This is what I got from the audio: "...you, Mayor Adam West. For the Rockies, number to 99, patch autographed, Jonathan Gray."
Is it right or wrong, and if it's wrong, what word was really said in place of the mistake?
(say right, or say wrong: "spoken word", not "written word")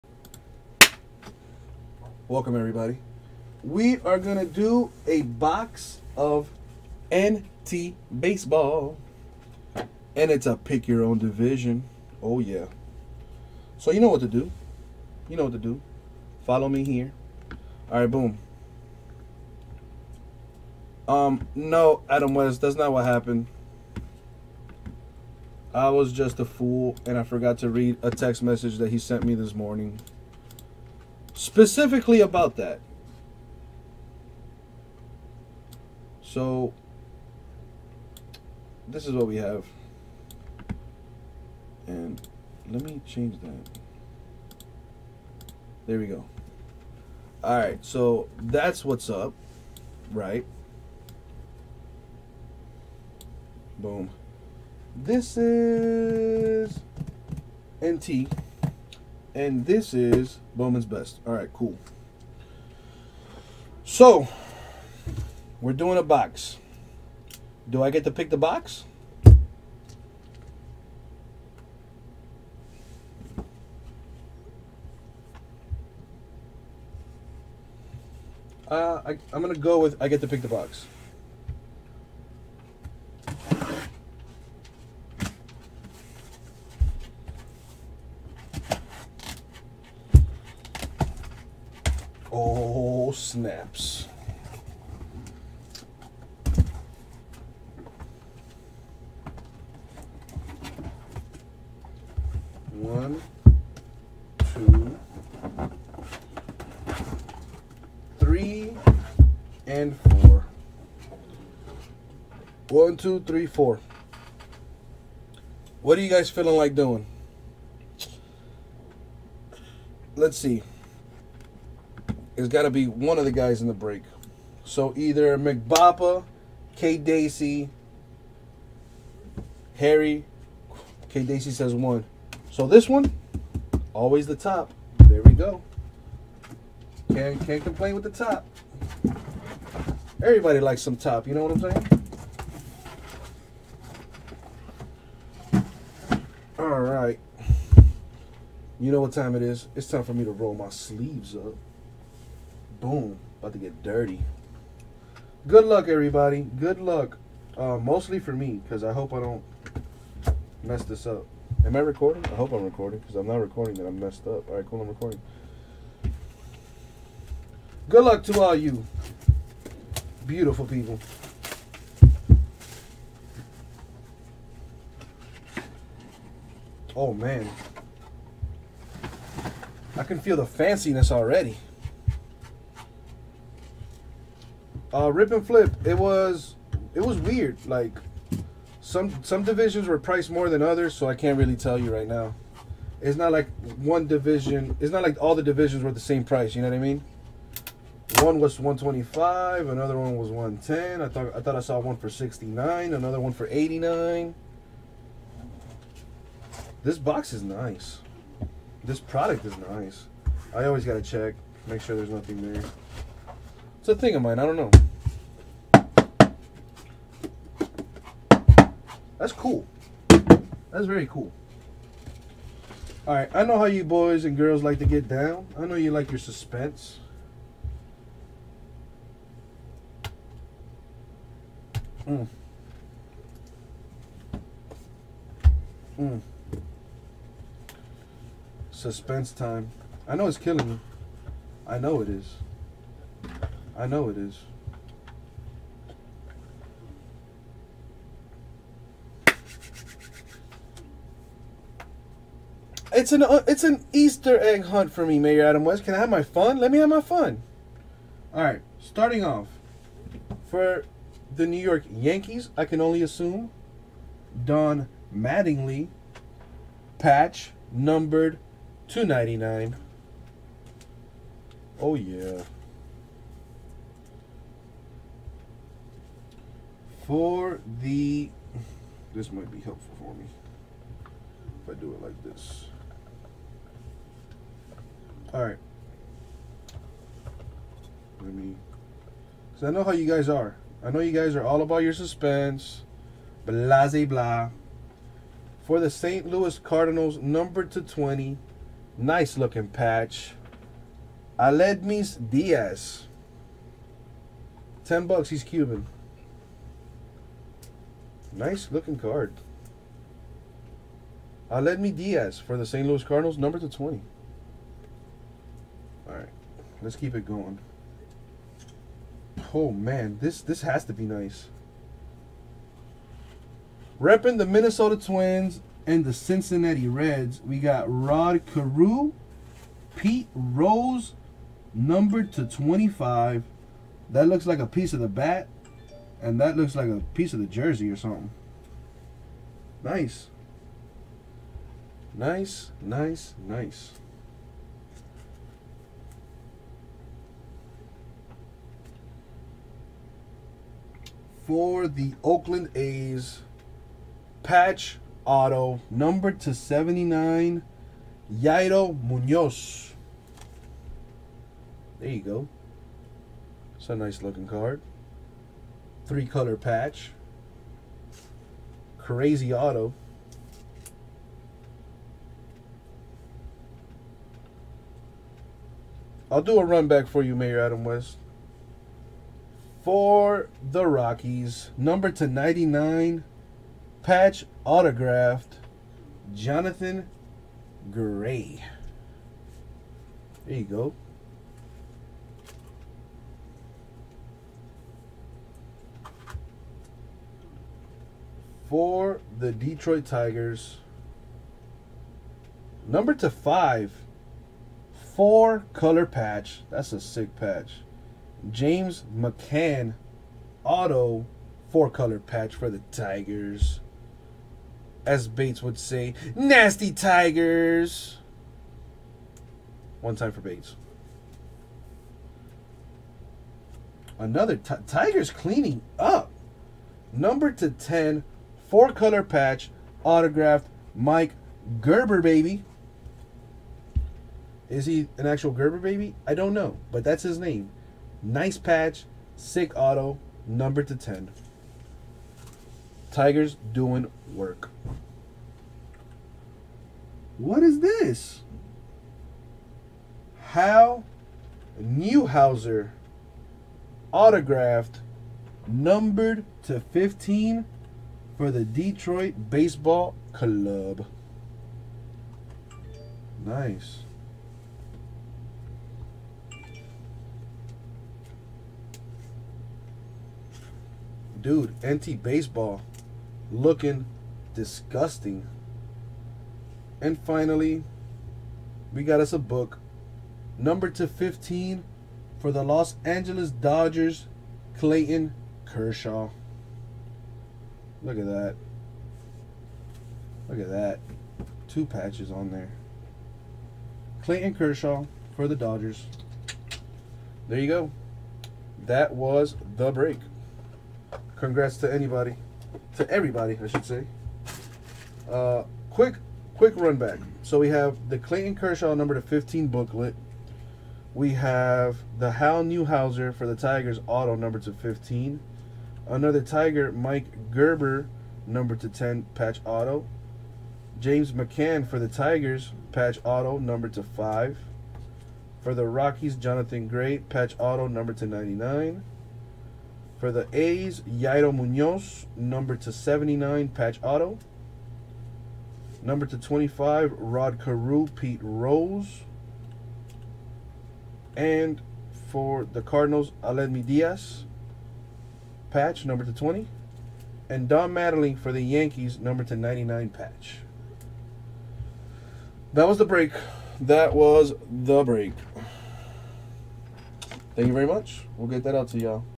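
right.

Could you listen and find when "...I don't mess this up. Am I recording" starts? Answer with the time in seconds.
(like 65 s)
159 s.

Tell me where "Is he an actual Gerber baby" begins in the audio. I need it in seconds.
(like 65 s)
434 s.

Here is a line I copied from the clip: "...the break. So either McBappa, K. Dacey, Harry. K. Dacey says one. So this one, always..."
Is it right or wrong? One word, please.
right.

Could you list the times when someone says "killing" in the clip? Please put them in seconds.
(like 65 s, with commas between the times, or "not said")
240 s.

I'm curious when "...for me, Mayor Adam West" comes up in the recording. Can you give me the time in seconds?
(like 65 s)
254 s.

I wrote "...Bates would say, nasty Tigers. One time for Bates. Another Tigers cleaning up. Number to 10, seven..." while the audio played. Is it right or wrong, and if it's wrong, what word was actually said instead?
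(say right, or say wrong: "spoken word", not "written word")
wrong: "four", not "seven".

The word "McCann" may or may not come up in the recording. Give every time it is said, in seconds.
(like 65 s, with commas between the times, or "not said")
409 s, 521 s.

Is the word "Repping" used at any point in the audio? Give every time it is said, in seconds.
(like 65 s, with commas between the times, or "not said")
323 s.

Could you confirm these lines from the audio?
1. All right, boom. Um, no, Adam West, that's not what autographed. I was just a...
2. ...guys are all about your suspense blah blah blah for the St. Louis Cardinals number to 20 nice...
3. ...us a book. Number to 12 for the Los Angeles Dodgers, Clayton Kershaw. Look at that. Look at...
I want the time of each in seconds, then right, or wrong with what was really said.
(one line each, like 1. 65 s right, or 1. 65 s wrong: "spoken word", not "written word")
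1. 17 s wrong: "happened", not "autographed"
2. 291 s right
3. 479 s wrong: "15", not "12".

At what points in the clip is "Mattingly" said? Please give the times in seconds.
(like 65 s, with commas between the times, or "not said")
265 s, 547 s.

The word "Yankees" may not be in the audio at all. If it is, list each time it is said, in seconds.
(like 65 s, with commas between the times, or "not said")
261 s, 548 s.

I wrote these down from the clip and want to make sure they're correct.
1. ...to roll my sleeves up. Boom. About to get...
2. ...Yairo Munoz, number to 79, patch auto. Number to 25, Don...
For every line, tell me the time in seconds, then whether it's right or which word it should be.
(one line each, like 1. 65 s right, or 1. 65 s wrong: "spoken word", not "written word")
1. 150 s right
2. 531 s wrong: "Rod", not "Don".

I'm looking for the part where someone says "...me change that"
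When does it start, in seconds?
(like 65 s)
42 s.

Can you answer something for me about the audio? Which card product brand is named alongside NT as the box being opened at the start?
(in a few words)
Bowman's Best.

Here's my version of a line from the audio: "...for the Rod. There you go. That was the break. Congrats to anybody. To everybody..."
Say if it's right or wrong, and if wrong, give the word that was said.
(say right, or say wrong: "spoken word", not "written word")
wrong: "Dodgers", not "Rod".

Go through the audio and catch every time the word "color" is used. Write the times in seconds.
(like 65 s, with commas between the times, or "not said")
366 s, 405 s, 411 s, 428 s.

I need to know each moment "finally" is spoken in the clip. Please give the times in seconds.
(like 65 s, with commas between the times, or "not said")
477 s.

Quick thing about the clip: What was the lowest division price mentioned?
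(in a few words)
69.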